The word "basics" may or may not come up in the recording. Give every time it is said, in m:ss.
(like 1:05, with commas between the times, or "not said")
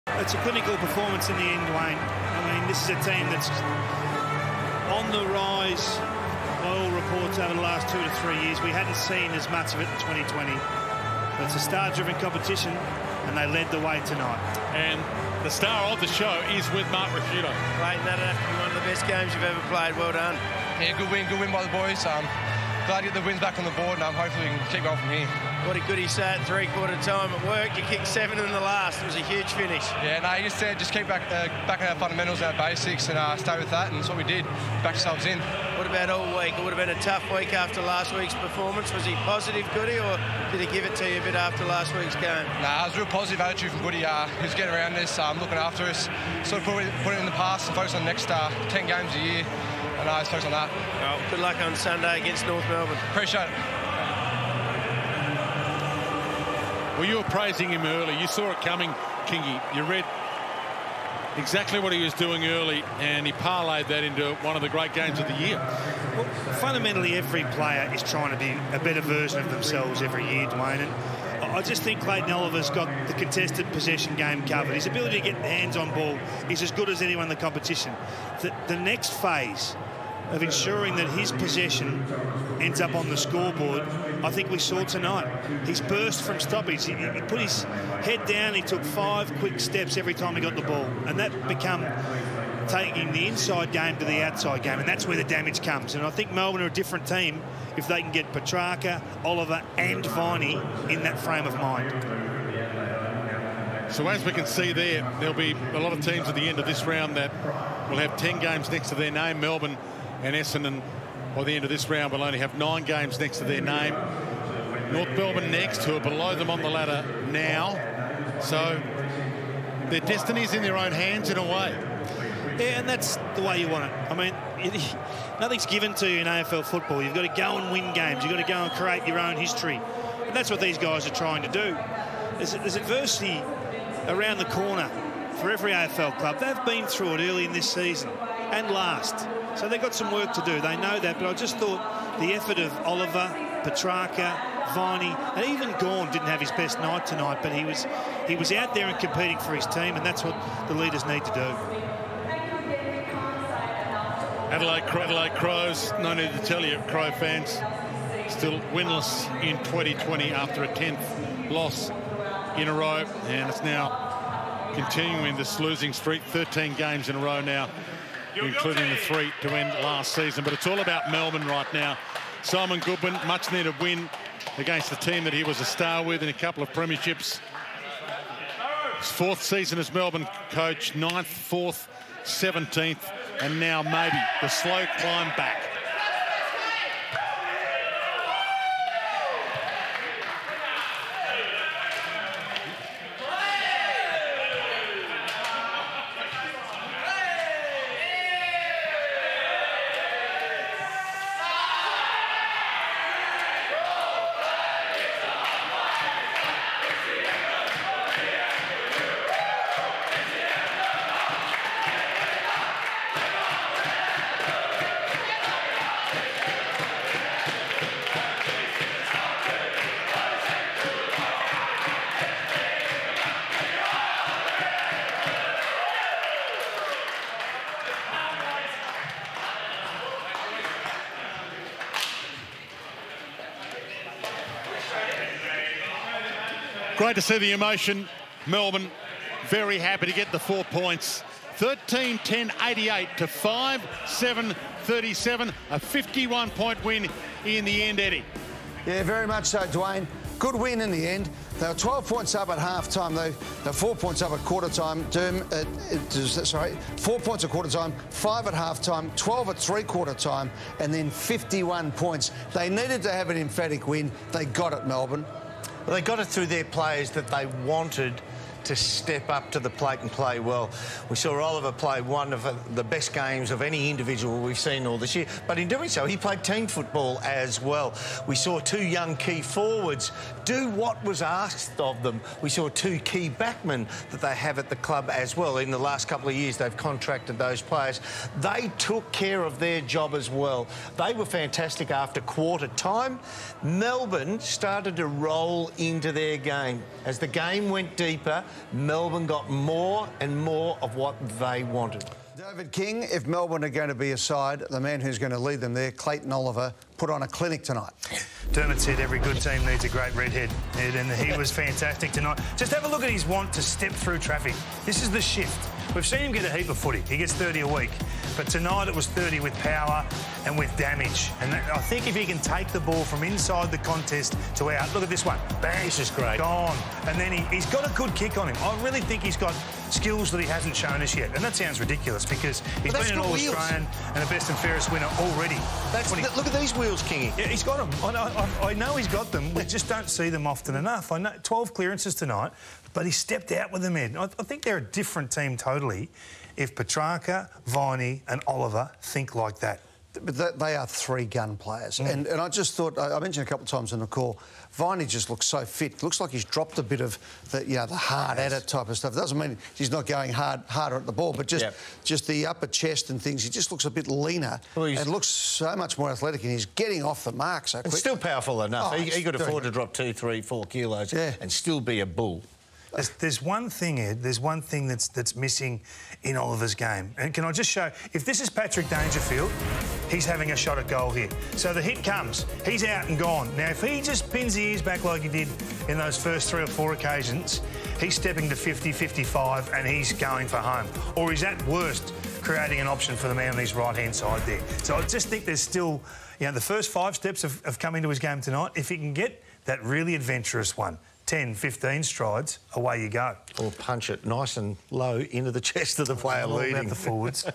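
0:32.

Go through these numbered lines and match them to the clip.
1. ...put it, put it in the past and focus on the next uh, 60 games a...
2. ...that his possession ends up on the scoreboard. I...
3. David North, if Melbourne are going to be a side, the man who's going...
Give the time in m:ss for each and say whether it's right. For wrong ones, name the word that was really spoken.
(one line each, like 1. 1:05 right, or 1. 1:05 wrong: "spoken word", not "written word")
1. 0:46 wrong: "10", not "60"
2. 1:20 right
3. 5:02 wrong: "King", not "North".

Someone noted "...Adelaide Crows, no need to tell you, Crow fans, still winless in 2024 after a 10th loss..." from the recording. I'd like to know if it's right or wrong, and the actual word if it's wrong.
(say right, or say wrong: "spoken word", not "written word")
wrong: "2020", not "2024".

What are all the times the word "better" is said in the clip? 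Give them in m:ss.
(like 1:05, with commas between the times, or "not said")
1:08.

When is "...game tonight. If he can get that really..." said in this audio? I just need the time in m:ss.
6:38.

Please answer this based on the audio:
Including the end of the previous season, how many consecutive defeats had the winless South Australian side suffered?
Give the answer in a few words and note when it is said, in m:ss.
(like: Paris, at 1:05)
13, at 2:46.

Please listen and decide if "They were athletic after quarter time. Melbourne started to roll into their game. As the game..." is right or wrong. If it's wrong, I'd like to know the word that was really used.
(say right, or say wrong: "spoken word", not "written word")
wrong: "fantastic", not "athletic".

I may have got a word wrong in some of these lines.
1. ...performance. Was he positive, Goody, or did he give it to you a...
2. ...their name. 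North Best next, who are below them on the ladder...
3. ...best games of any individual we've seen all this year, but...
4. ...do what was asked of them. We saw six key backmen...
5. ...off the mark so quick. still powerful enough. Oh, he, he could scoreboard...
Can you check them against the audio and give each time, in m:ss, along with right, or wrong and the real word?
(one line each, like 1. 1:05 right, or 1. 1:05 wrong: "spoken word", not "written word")
1. 0:38 right
2. 1:53 wrong: "Melbourne", not "Best"
3. 4:32 right
4. 4:40 wrong: "two", not "six"
5. 6:07 wrong: "afford", not "scoreboard".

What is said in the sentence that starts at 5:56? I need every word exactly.
Looks like he's dropped a bit of the, you know, the hard yes.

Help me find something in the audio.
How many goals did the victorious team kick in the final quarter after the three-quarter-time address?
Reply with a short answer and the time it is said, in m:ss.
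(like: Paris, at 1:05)
7, at 0:28.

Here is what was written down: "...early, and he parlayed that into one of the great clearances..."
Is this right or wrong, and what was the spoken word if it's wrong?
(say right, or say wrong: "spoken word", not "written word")
wrong: "games", not "clearances".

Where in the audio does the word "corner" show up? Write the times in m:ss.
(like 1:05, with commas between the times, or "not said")
2:14.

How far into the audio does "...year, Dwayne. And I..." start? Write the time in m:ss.
1:10.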